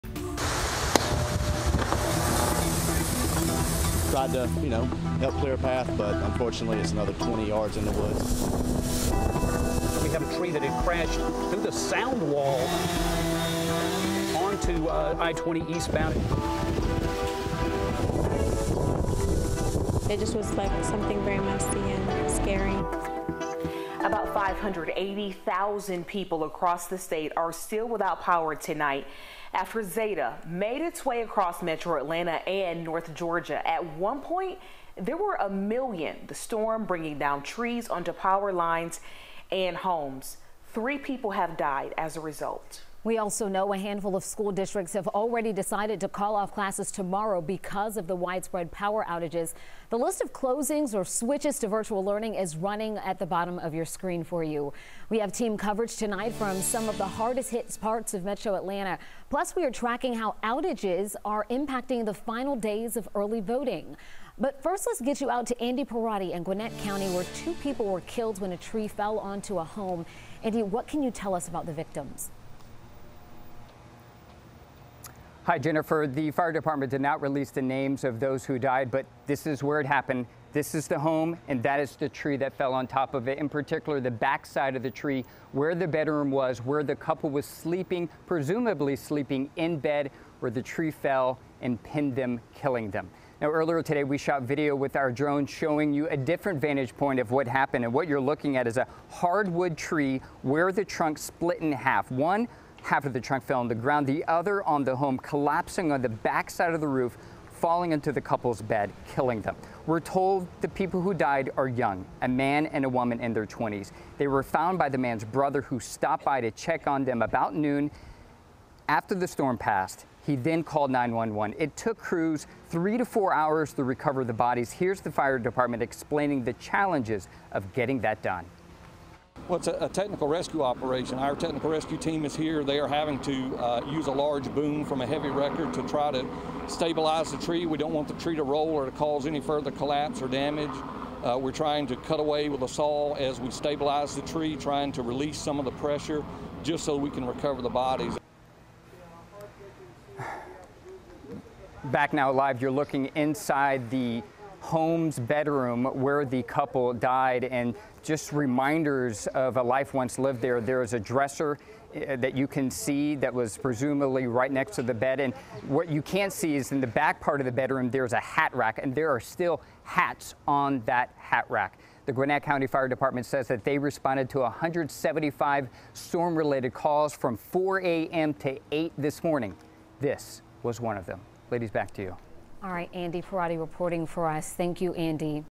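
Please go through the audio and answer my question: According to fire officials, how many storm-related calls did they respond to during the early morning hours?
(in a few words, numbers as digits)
175.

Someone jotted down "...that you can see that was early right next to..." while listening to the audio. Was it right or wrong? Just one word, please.
wrong.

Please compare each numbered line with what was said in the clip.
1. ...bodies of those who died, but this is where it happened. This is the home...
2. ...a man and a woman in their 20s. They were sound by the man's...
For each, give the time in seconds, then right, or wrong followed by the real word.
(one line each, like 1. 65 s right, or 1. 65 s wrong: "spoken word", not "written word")
1. 77 s wrong: "names", not "bodies"
2. 112 s wrong: "found", not "sound".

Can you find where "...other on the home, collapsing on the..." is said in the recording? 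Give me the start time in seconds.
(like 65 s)
104 s.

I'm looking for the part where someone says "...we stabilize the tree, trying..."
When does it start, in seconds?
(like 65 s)
143 s.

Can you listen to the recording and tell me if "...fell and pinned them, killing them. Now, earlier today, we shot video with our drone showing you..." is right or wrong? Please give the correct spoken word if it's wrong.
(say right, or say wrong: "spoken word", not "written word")
right.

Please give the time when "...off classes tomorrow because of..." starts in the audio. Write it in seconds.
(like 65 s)
46 s.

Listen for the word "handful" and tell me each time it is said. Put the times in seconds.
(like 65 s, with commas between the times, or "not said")
43 s.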